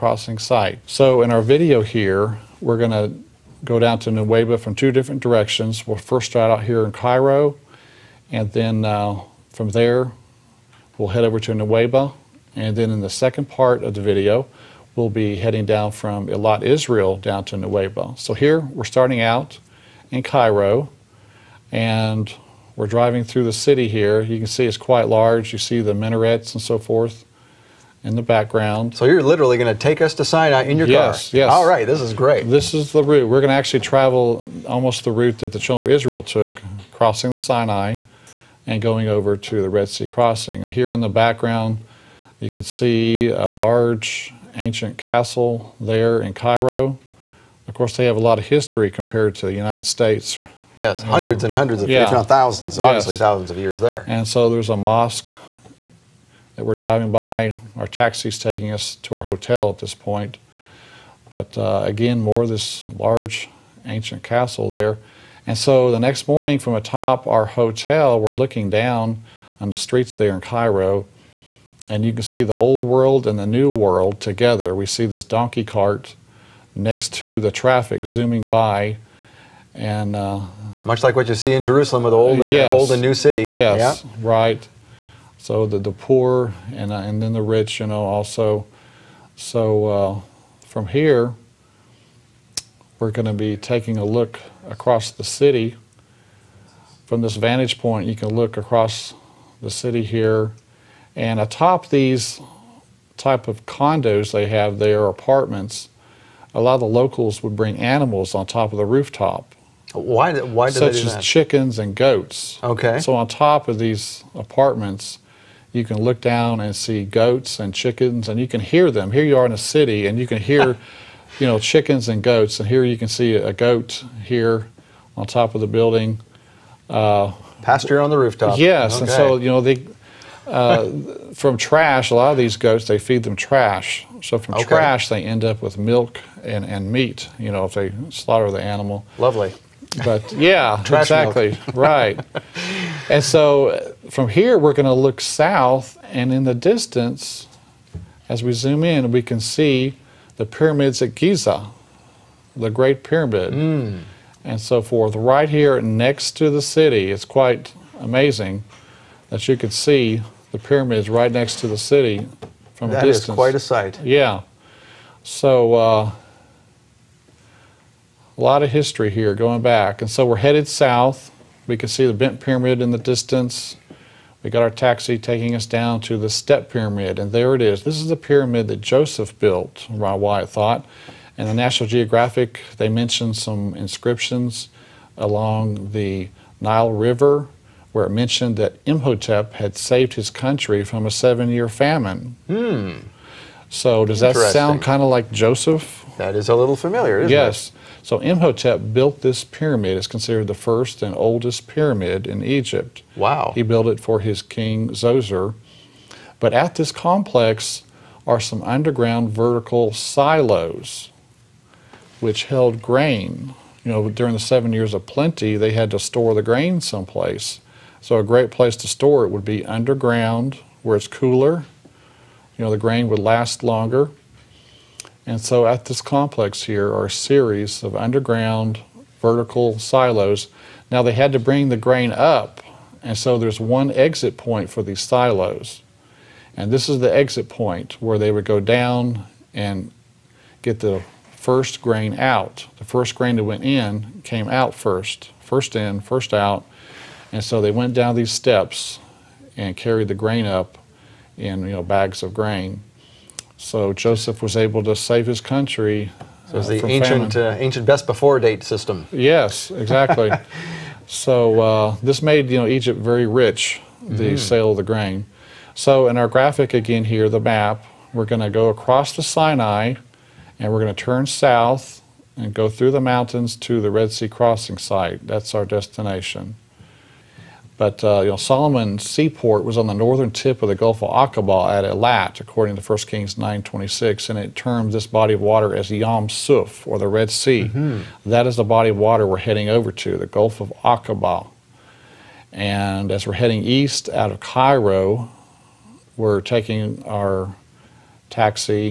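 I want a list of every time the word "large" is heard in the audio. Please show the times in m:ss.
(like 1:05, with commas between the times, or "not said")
0:25, 0:43, 1:02.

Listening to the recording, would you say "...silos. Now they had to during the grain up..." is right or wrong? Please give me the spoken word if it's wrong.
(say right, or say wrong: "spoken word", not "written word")
wrong: "bring", not "during".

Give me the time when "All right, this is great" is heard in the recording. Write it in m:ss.
0:31.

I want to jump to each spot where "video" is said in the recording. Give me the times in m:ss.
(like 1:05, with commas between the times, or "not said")
0:01, 0:14.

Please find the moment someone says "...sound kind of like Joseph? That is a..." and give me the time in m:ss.
3:14.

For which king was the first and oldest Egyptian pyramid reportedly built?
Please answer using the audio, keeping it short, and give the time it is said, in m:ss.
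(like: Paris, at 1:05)
Zoser, at 3:24.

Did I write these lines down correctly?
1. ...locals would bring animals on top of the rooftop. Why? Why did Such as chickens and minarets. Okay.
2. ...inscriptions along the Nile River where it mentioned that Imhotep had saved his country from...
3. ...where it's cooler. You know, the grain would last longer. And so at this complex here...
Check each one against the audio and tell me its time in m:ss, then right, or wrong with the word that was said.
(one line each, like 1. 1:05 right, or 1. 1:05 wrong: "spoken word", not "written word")
1. 1:46 wrong: "goats", not "minarets"
2. 3:03 right
3. 3:40 right.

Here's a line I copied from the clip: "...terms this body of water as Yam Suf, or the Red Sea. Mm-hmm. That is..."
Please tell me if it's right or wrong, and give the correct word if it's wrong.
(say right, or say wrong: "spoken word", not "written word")
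right.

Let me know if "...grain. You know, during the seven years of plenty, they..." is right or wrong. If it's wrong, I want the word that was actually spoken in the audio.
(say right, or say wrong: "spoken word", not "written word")
right.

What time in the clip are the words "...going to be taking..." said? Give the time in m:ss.
1:33.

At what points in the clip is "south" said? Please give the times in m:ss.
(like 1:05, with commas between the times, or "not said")
2:25, 2:50, 4:31.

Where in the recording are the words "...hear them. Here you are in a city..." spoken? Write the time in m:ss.
1:58.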